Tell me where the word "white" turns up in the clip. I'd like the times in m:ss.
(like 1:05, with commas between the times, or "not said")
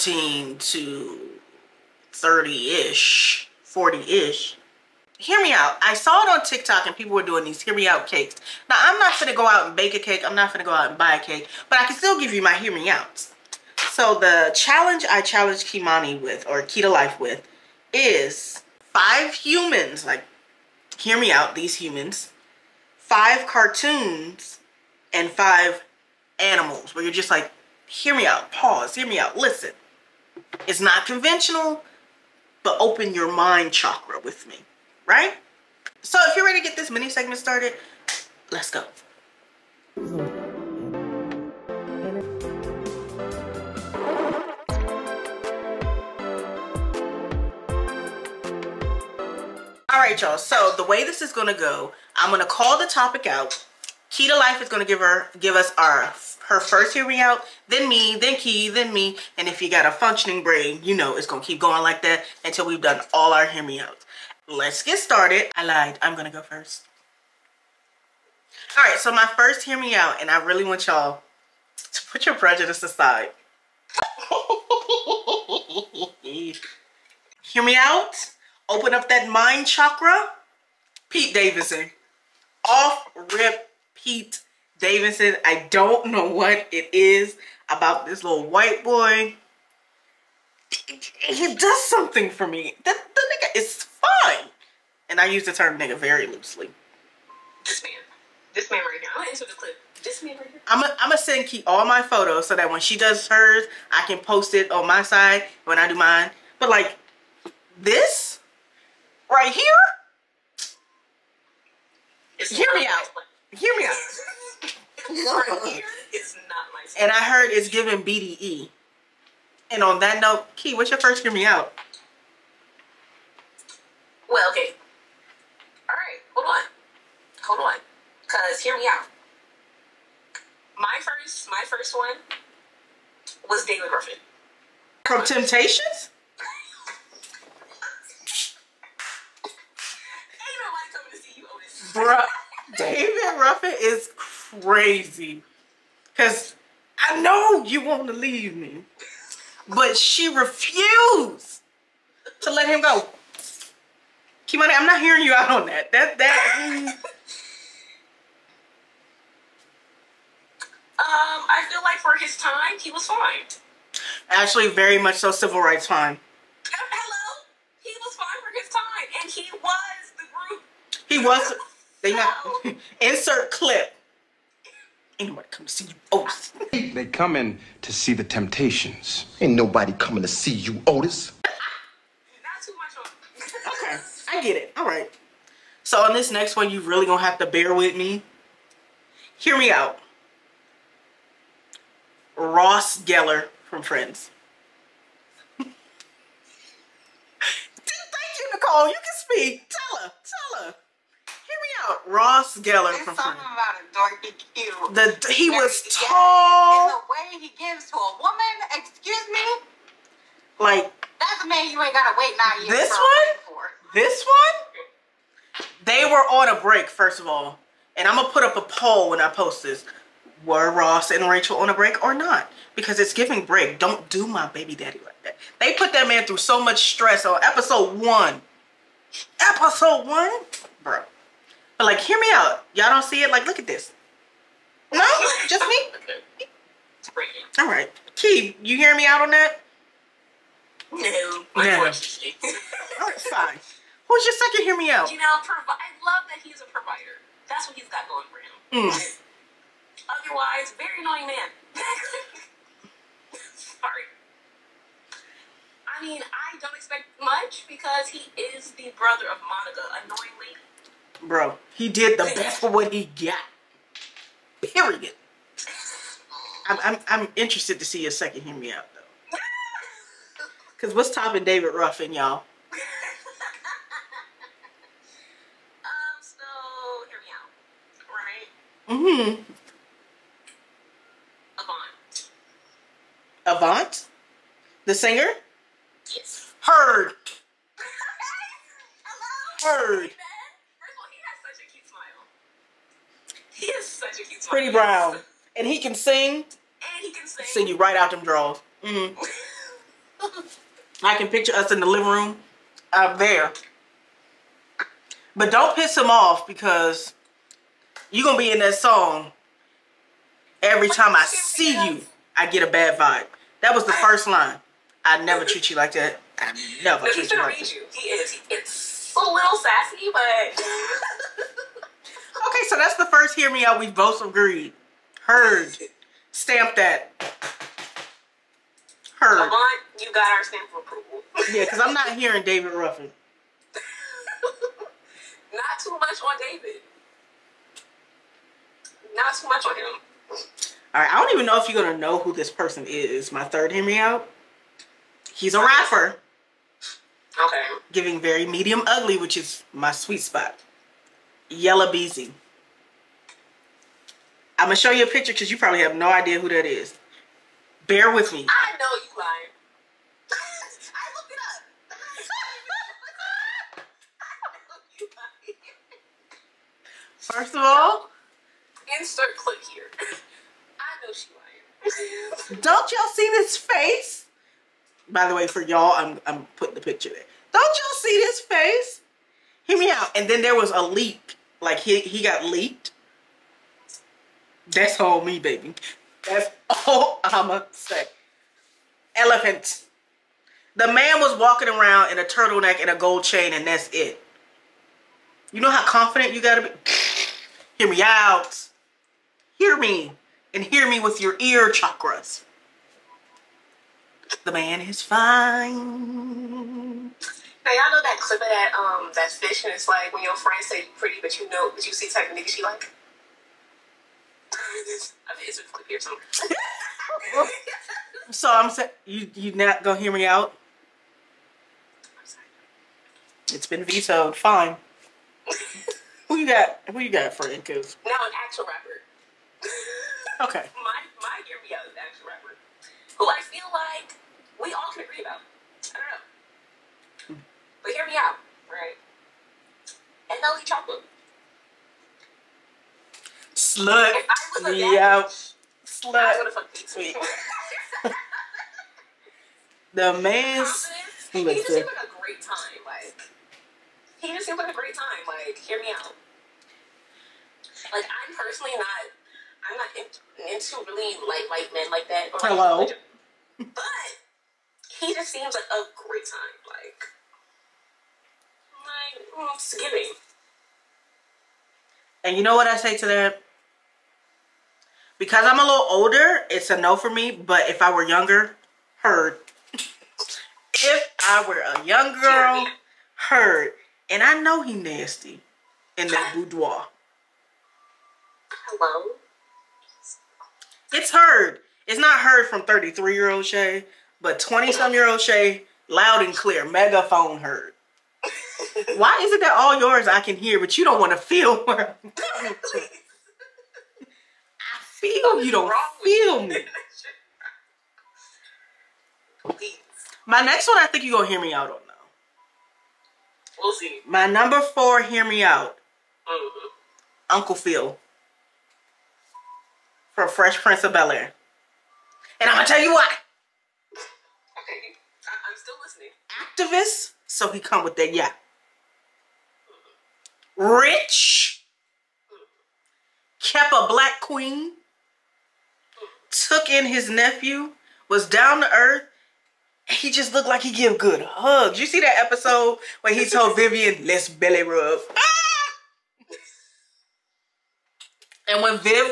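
1:28, 7:41.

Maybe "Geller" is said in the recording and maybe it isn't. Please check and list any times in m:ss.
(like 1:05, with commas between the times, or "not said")
3:12, 3:22.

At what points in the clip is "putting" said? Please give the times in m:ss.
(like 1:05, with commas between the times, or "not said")
6:16.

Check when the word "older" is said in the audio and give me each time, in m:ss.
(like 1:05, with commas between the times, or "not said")
7:55.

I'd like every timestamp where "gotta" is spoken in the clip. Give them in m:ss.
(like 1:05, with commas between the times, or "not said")
3:31, 6:36.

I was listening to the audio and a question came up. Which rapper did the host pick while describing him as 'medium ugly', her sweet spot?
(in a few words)
Yella Beezy.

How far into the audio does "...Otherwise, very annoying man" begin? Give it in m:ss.
4:10.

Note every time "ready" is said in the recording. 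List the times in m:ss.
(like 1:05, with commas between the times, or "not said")
0:36.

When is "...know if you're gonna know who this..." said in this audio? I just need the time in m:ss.
5:41.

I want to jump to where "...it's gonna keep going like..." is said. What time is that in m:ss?
1:01.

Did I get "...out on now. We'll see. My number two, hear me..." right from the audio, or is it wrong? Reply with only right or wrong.
wrong.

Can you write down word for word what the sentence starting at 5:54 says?
I'm gonna show you a picture because you probably have no idea who that is.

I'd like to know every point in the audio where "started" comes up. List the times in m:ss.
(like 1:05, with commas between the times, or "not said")
0:37, 1:04.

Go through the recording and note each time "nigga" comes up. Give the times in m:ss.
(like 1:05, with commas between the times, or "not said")
1:35, 6:52.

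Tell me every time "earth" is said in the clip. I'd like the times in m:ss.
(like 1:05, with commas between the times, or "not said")
8:58.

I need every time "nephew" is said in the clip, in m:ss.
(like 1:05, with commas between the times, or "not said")
8:57.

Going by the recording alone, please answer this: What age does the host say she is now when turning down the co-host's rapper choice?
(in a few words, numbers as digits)
33.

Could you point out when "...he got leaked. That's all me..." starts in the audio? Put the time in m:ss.
6:21.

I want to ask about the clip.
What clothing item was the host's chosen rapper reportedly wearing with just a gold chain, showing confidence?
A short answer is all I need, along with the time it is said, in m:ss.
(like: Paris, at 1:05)
Turtleneck, at 6:32.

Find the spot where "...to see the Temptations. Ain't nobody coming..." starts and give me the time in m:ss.
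2:57.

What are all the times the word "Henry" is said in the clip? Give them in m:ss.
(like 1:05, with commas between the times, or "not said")
5:43.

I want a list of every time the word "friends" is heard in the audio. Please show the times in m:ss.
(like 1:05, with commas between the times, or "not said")
3:13, 6:50.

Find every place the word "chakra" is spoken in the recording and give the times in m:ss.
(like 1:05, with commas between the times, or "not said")
0:33, 1:19, 6:41.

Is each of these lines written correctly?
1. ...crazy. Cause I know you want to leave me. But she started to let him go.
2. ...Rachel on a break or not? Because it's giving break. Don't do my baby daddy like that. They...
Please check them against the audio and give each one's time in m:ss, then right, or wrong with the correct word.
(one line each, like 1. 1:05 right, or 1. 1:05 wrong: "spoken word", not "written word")
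1. 2:24 wrong: "refused", not "started"
2. 3:41 right.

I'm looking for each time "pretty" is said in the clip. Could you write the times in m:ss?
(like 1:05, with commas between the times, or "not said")
4:54, 6:50.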